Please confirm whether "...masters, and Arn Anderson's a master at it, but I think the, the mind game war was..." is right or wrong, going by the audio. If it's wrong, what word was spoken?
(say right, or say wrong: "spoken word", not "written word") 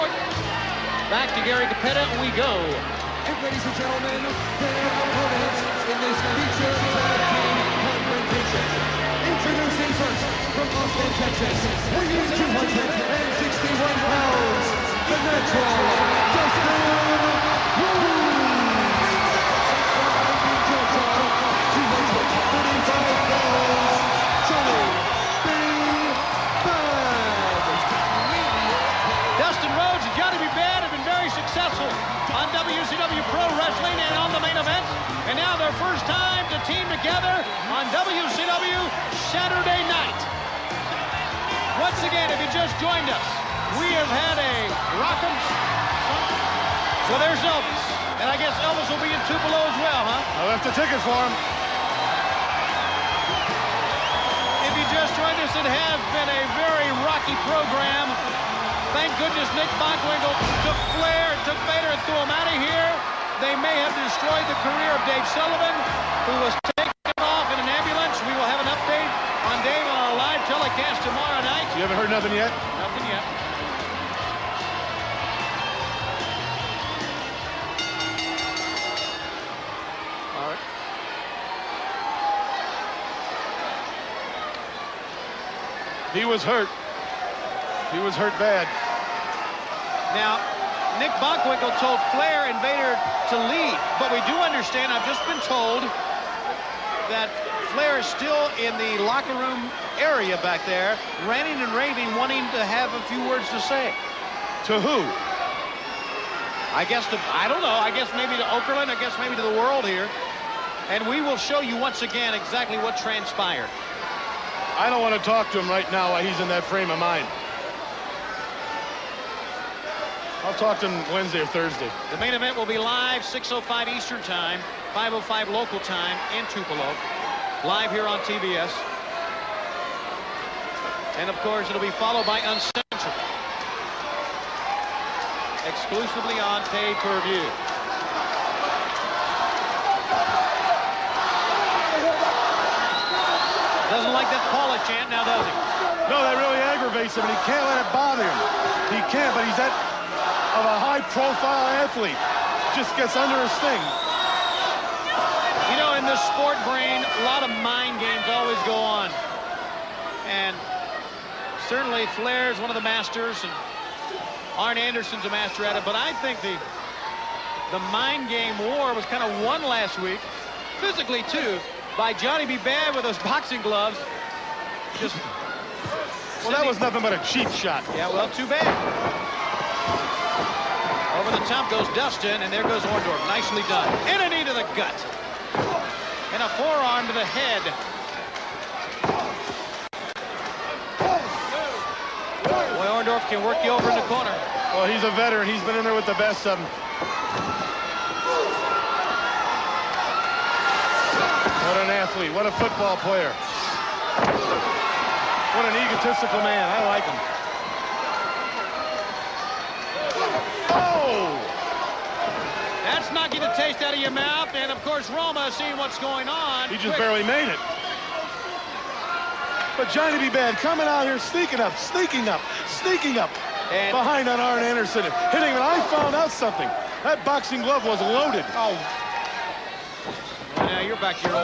right.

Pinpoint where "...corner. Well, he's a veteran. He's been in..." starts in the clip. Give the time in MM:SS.
03:14.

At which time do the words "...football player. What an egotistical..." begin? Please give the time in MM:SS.
03:22.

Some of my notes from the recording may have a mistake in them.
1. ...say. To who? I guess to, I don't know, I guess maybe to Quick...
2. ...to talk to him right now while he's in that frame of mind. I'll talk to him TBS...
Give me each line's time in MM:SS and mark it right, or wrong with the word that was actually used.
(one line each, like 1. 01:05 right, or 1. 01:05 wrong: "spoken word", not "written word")
1. 01:43 wrong: "Okerlund", not "Quick"
2. 01:55 wrong: "Wednesday", not "TBS".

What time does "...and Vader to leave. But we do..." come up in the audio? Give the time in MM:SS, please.
01:32.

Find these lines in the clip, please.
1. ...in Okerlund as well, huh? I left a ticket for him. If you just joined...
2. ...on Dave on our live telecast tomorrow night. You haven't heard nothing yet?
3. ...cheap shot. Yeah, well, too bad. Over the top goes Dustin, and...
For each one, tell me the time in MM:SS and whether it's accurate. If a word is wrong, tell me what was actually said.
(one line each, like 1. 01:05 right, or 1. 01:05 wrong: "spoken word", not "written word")
1. 00:49 wrong: "Tupelo", not "Okerlund"
2. 01:09 right
3. 02:57 right.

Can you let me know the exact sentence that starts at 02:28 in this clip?
He can't, but he's at of a high-profile athlete just gets under his skin.